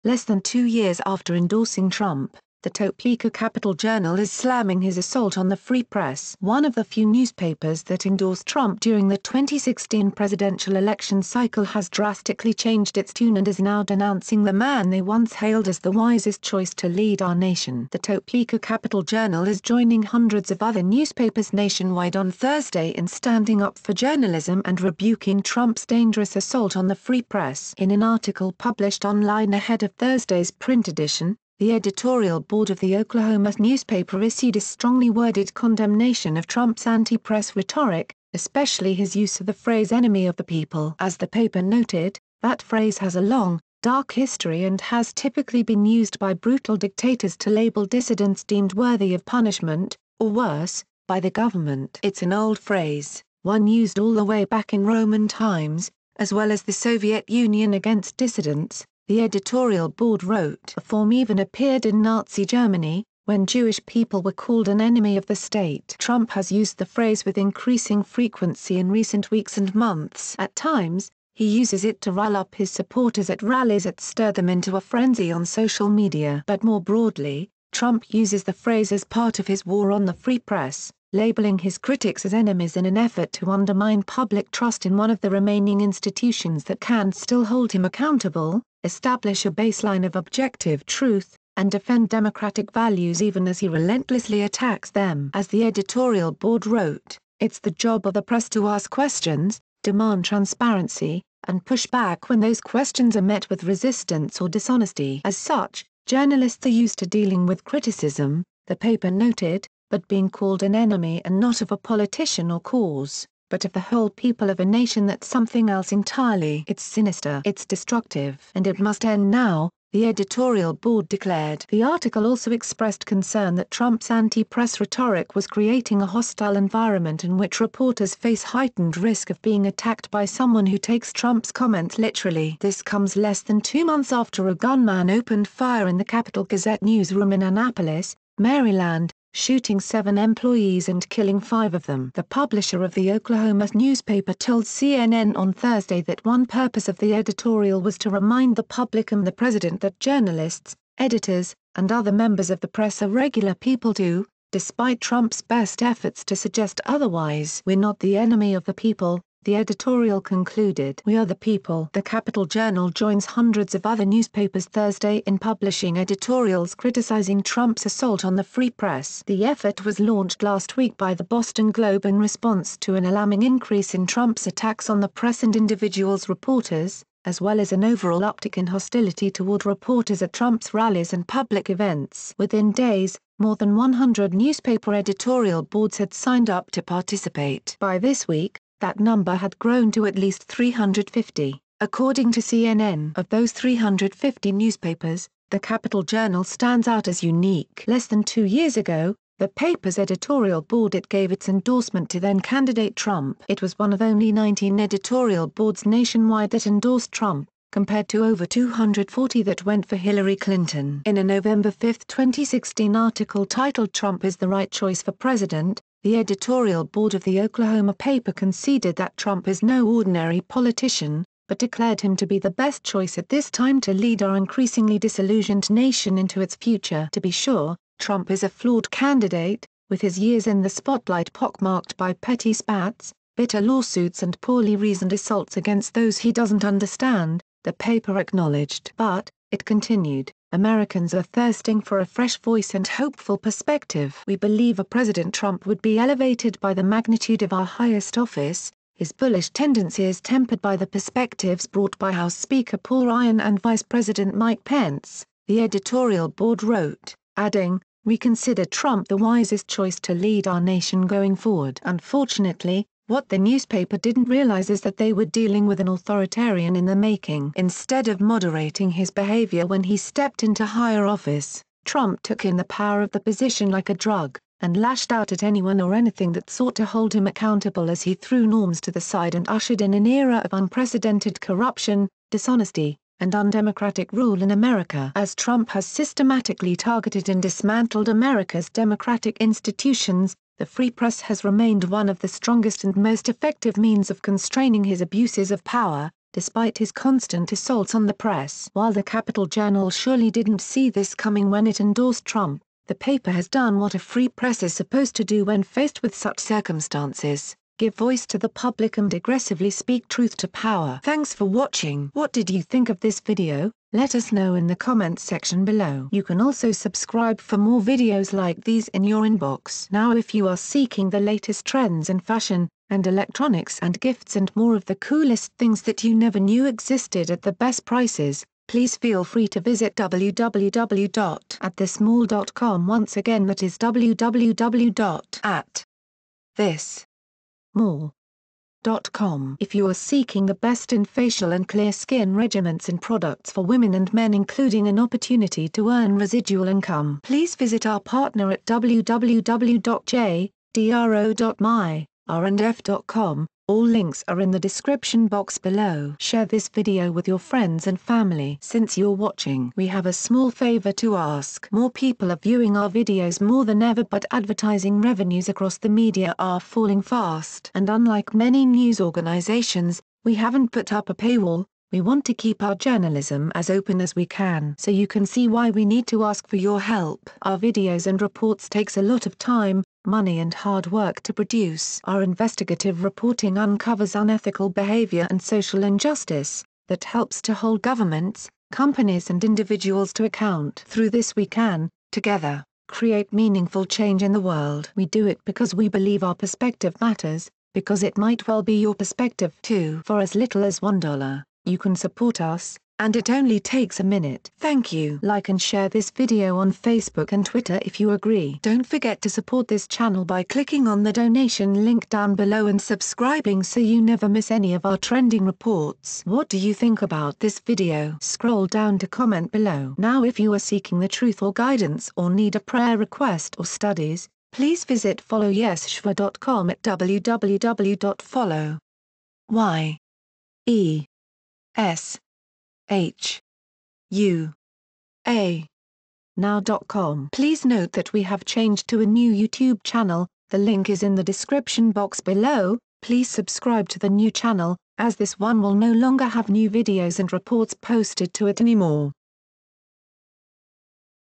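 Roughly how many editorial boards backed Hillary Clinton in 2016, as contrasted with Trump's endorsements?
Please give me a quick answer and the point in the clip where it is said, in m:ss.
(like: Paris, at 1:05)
over 240, at 3:28.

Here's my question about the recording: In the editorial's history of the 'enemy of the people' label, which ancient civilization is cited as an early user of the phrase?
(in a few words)
Roman.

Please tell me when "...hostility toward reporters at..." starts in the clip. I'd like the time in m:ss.
2:58.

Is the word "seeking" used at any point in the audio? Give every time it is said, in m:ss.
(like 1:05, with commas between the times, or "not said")
5:20, 5:39, 7:00.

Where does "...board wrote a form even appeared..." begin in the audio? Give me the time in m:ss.
0:59.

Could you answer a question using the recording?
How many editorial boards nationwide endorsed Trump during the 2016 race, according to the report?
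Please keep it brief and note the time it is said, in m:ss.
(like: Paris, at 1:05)
19, at 3:24.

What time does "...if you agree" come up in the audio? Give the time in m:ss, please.
6:47.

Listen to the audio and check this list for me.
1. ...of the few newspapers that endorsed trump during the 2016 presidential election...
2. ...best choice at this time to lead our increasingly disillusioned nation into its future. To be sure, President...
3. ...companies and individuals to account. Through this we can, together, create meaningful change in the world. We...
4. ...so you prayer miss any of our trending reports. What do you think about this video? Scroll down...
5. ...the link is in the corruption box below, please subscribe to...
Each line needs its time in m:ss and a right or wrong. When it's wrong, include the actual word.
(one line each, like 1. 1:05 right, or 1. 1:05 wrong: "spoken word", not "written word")
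1. 0:06 right
2. 3:42 wrong: "Trump", not "President"
3. 6:28 right
4. 6:53 wrong: "never", not "prayer"
5. 7:20 wrong: "description", not "corruption".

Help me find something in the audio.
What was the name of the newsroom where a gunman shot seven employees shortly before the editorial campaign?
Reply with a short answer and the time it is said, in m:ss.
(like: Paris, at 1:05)
Capitol Gazette, at 2:16.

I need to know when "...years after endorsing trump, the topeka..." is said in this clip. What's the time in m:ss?
0:00.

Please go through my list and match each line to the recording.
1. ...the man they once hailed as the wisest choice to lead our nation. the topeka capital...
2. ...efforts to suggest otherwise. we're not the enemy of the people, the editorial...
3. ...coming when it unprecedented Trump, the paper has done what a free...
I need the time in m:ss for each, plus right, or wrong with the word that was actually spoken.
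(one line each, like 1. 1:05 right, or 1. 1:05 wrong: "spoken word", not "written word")
1. 0:14 right
2. 2:35 right
3. 5:01 wrong: "endorsed", not "unprecedented".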